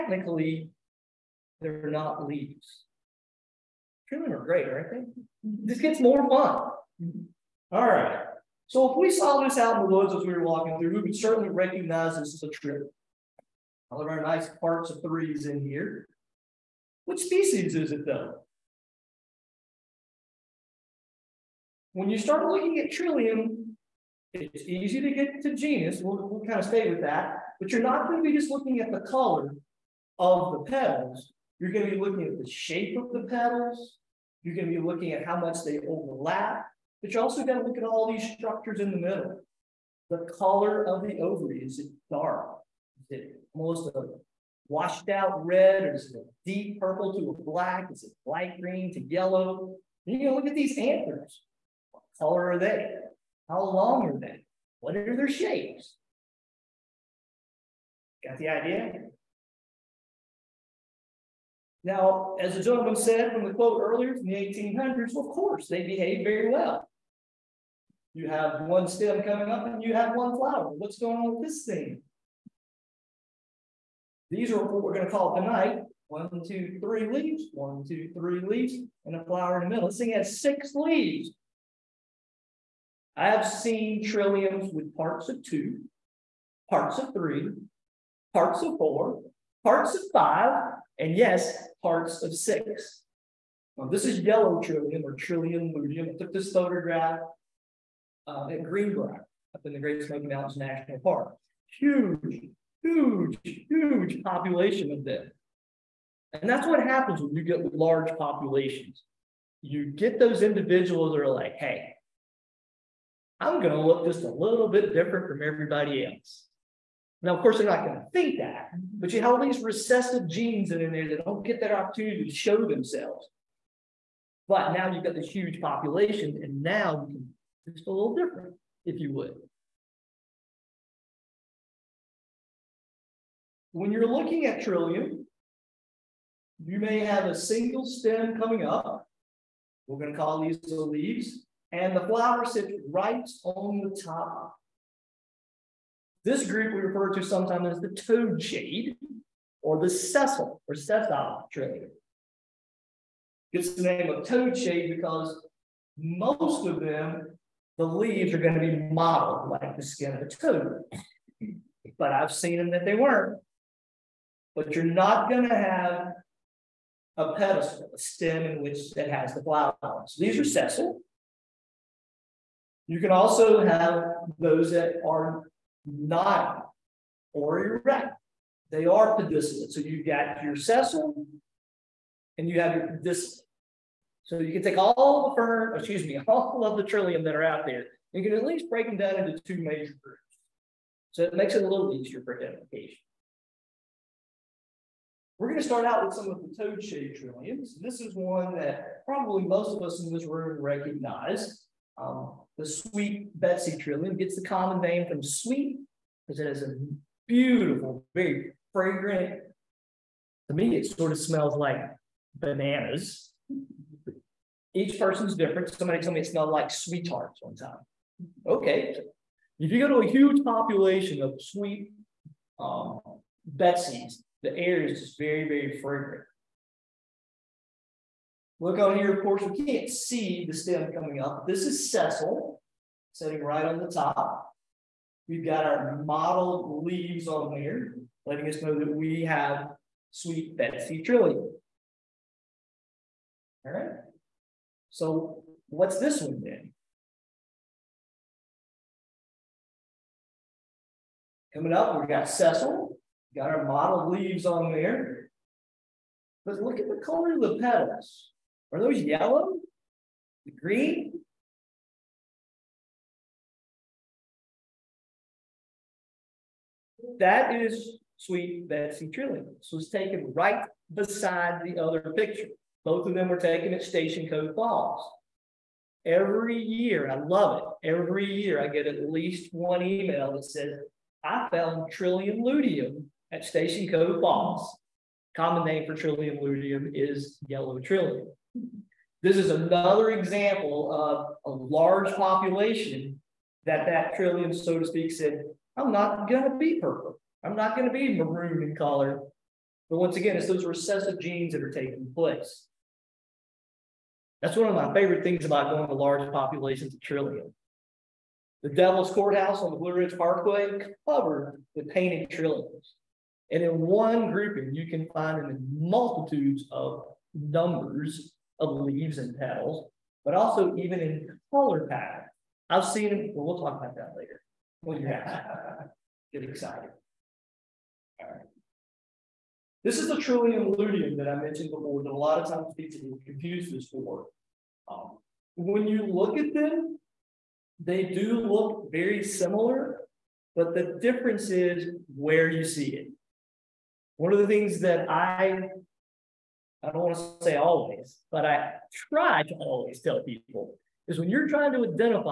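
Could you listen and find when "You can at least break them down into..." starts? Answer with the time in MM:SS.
03:08.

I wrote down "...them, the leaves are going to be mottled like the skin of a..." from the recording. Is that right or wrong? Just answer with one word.
right.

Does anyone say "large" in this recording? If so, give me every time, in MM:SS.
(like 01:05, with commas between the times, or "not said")
01:47, 04:51, 05:05.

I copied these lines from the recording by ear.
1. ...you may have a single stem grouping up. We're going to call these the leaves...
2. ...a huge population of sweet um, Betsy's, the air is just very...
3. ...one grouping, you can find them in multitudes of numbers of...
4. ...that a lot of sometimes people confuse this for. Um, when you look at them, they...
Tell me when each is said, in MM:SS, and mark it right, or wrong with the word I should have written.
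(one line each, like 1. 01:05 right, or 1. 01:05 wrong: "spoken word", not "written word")
1. 02:16 wrong: "coming", not "grouping"
2. 03:40 right
3. 05:13 right
4. 05:32 wrong: "times", not "sometimes".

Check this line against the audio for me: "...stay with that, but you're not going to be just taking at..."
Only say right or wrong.
wrong.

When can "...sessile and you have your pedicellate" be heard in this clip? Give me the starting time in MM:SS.
03:00.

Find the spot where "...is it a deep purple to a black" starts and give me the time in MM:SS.
00:45.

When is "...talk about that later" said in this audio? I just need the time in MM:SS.
05:23.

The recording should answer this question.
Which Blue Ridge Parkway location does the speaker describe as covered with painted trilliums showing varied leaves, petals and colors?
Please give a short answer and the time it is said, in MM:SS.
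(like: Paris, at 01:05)
Devil's Courthouse, at 05:08.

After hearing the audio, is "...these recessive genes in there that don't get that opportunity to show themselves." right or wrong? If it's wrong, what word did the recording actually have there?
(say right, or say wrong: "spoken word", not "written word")
right.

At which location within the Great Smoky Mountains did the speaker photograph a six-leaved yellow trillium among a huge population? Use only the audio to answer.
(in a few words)
Greenbrier.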